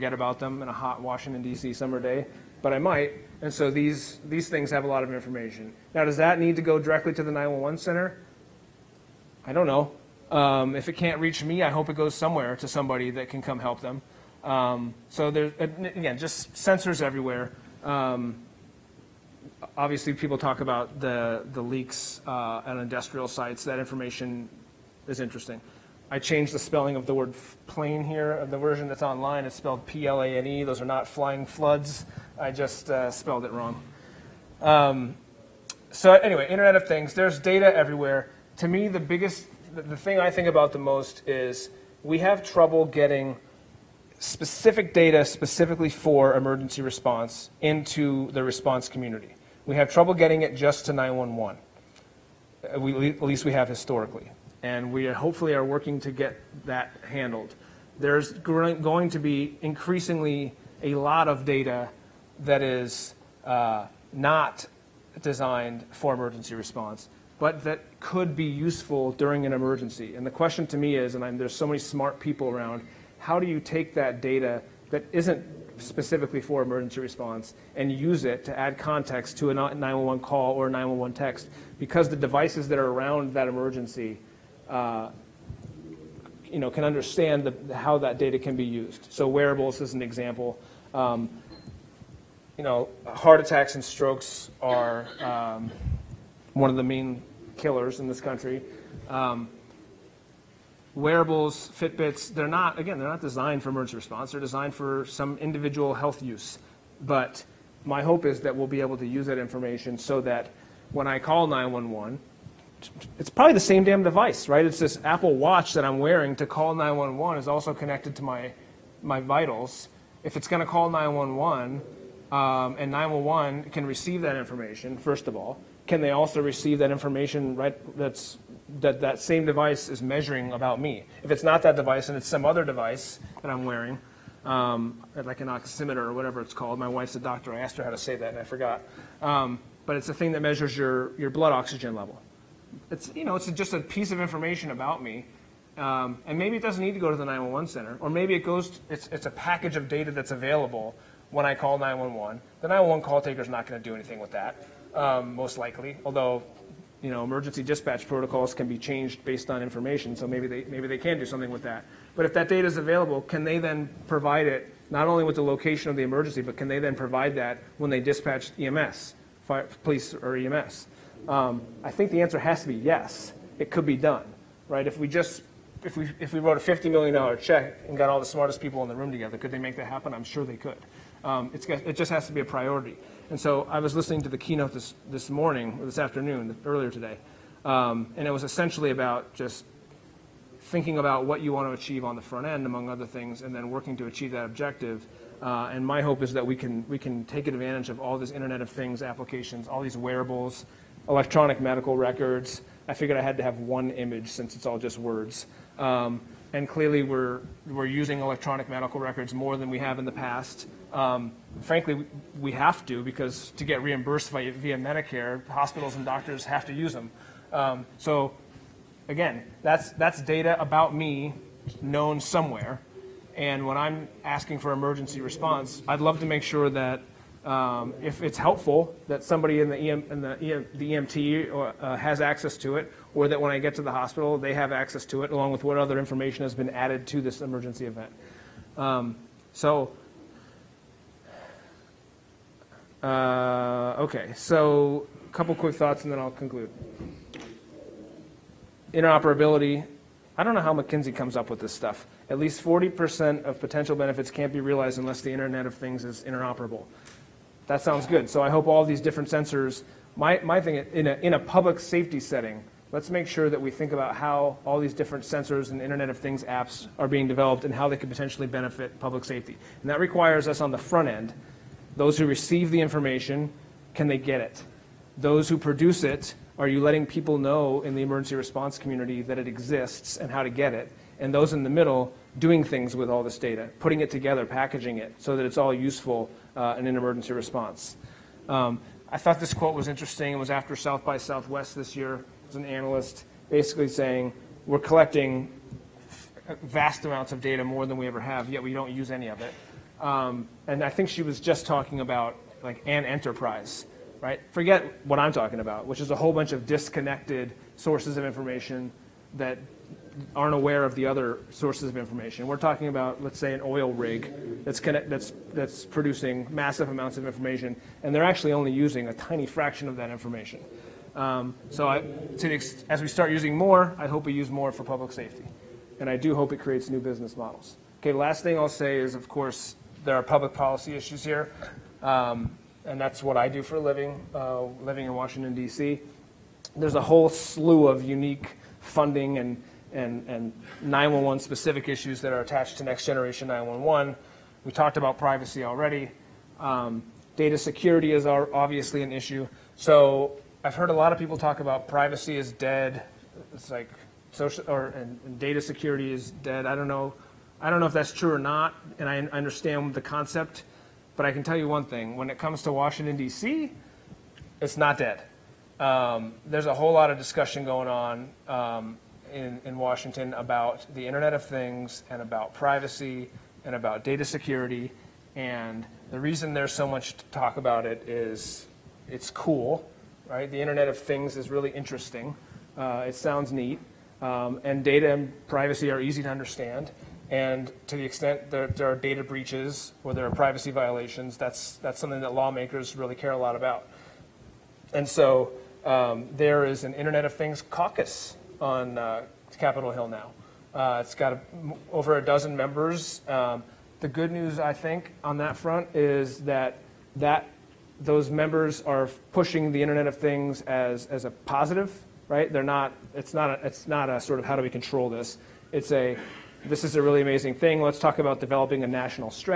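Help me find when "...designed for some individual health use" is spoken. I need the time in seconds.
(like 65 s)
104 s.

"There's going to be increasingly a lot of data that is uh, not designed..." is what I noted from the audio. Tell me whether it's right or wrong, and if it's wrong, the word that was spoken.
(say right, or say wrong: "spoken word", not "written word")
right.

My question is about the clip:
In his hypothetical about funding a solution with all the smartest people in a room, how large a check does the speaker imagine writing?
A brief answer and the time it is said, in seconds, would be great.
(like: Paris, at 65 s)
$50 million, at 176 s.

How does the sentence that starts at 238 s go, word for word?
Um, so, uh, okay, so a couple quick thoughts and then I'll conclude.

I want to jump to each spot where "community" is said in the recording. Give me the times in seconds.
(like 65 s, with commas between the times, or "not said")
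48 s, 278 s.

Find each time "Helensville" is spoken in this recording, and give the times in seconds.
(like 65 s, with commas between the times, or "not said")
not said.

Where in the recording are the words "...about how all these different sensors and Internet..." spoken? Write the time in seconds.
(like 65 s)
263 s.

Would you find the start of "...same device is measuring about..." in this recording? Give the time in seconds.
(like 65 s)
129 s.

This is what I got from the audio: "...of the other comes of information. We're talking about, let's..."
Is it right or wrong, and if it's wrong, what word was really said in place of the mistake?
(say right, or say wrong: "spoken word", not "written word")
wrong: "sources", not "comes".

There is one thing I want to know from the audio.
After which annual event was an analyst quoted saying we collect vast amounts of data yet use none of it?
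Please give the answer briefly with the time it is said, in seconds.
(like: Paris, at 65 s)
South by Southwest, at 290 s.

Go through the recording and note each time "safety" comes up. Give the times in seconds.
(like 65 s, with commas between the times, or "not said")
261 s, 269 s, 325 s.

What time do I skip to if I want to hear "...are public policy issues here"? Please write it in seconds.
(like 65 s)
330 s.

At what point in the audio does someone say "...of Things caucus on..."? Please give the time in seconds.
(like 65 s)
397 s.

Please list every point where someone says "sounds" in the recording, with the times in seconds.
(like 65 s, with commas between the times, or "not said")
257 s, 383 s.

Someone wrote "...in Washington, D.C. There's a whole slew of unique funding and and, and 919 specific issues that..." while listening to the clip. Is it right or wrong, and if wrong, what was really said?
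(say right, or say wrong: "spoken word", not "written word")
wrong: "911", not "919".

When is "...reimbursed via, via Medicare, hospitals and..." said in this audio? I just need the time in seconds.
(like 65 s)
213 s.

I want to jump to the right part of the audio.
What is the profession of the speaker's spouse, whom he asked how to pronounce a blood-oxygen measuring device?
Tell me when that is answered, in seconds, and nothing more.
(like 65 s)
137 s.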